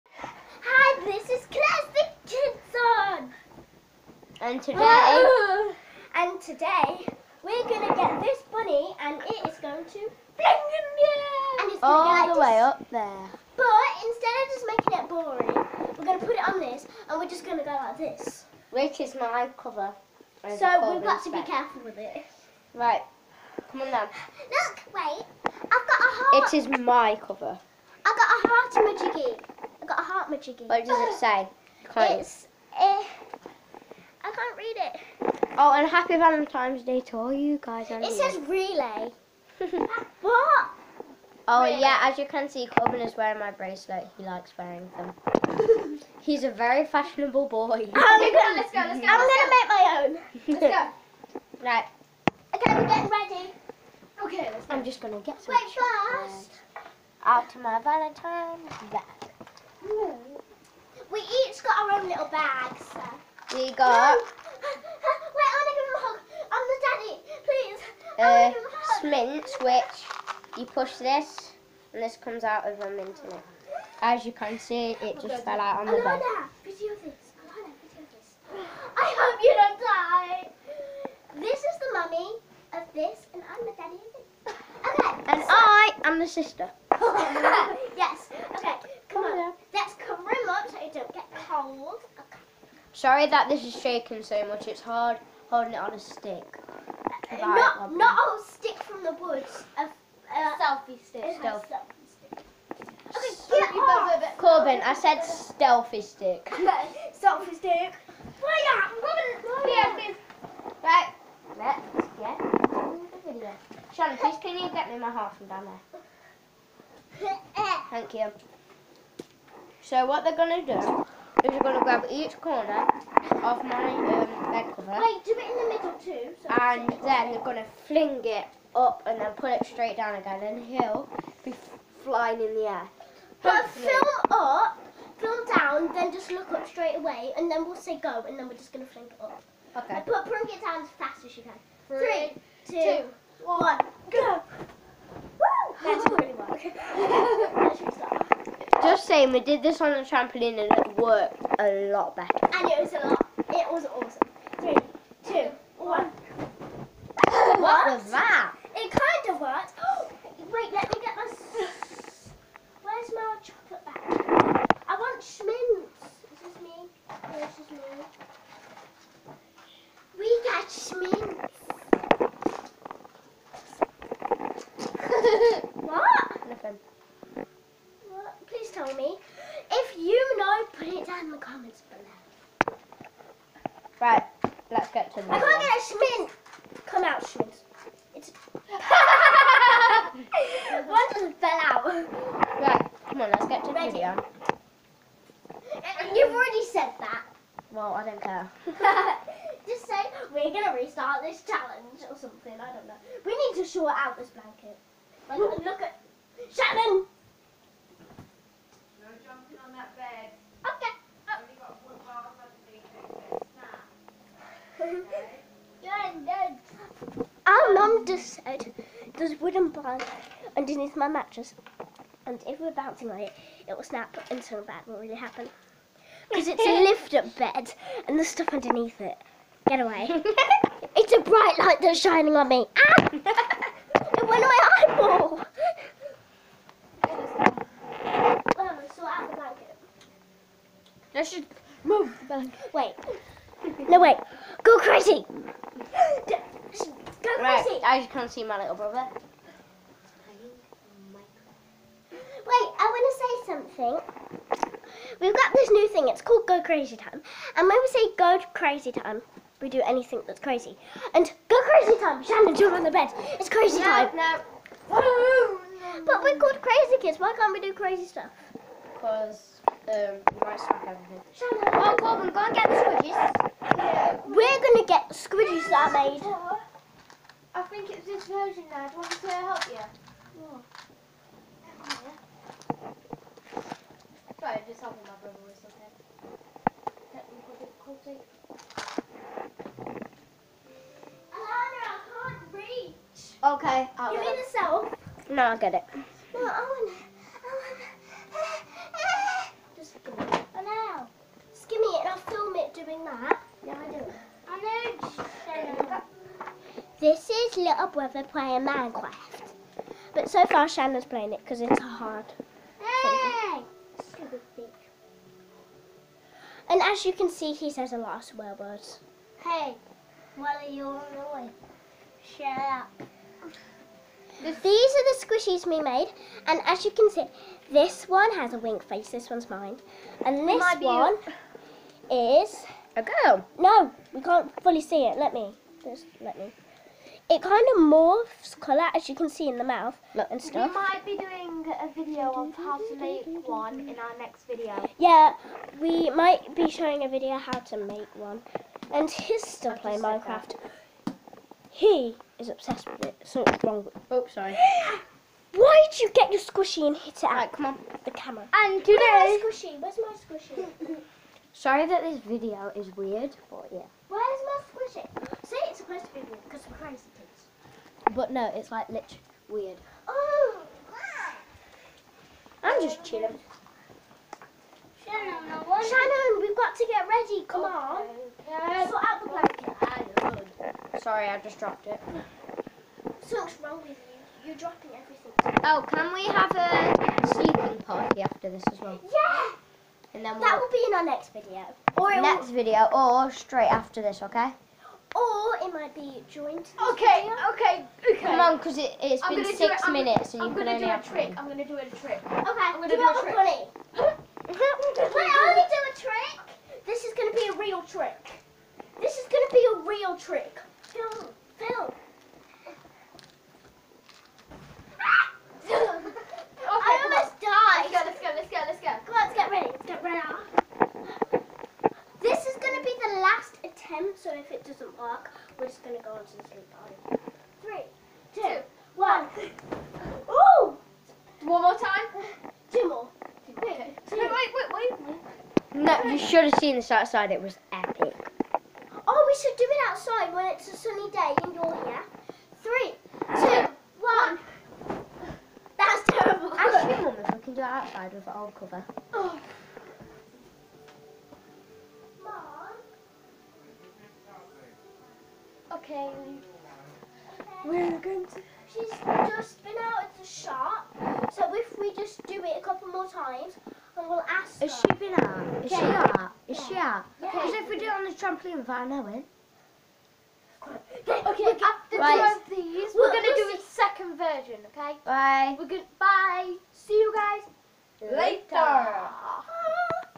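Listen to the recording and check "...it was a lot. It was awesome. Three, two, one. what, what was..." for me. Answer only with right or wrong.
right.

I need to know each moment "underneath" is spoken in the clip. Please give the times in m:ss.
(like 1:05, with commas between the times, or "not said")
3:40, 3:48.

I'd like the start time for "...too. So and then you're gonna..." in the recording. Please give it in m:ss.
2:06.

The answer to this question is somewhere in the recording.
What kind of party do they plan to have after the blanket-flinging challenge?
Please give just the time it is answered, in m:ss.
6:27.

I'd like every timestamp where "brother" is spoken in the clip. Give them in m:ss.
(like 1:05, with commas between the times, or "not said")
4:08, 4:45, 5:07.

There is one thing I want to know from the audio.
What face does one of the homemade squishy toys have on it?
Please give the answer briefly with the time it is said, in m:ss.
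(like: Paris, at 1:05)
A wink face, at 5:28.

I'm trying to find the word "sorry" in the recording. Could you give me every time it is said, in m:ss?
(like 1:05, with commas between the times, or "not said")
1:32, 5:54, 6:01, 6:20.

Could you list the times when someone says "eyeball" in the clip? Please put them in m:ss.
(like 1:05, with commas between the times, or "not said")
3:54.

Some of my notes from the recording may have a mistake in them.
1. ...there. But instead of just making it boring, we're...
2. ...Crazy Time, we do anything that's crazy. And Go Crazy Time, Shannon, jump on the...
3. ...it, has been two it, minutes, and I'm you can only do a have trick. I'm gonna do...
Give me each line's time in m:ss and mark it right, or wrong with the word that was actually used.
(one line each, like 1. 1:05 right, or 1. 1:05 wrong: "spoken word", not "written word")
1. 0:12 right
2. 4:18 right
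3. 6:38 wrong: "six", not "two".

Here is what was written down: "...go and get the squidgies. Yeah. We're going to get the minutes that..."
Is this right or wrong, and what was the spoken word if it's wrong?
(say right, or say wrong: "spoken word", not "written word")
wrong: "squidgies", not "minutes".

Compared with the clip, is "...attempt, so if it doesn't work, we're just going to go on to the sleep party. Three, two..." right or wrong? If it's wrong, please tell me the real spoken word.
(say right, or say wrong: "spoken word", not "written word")
right.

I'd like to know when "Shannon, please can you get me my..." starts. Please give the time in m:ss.
1:53.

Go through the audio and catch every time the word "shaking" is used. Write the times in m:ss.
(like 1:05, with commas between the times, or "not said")
1:33.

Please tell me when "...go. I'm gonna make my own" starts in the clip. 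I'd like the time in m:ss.
0:48.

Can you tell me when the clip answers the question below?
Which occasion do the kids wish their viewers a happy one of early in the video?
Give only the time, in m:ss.
0:36.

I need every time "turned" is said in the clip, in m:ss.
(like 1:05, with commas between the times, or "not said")
not said.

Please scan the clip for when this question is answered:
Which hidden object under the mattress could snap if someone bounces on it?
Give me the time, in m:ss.
3:39.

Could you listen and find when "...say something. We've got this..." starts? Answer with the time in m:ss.
4:13.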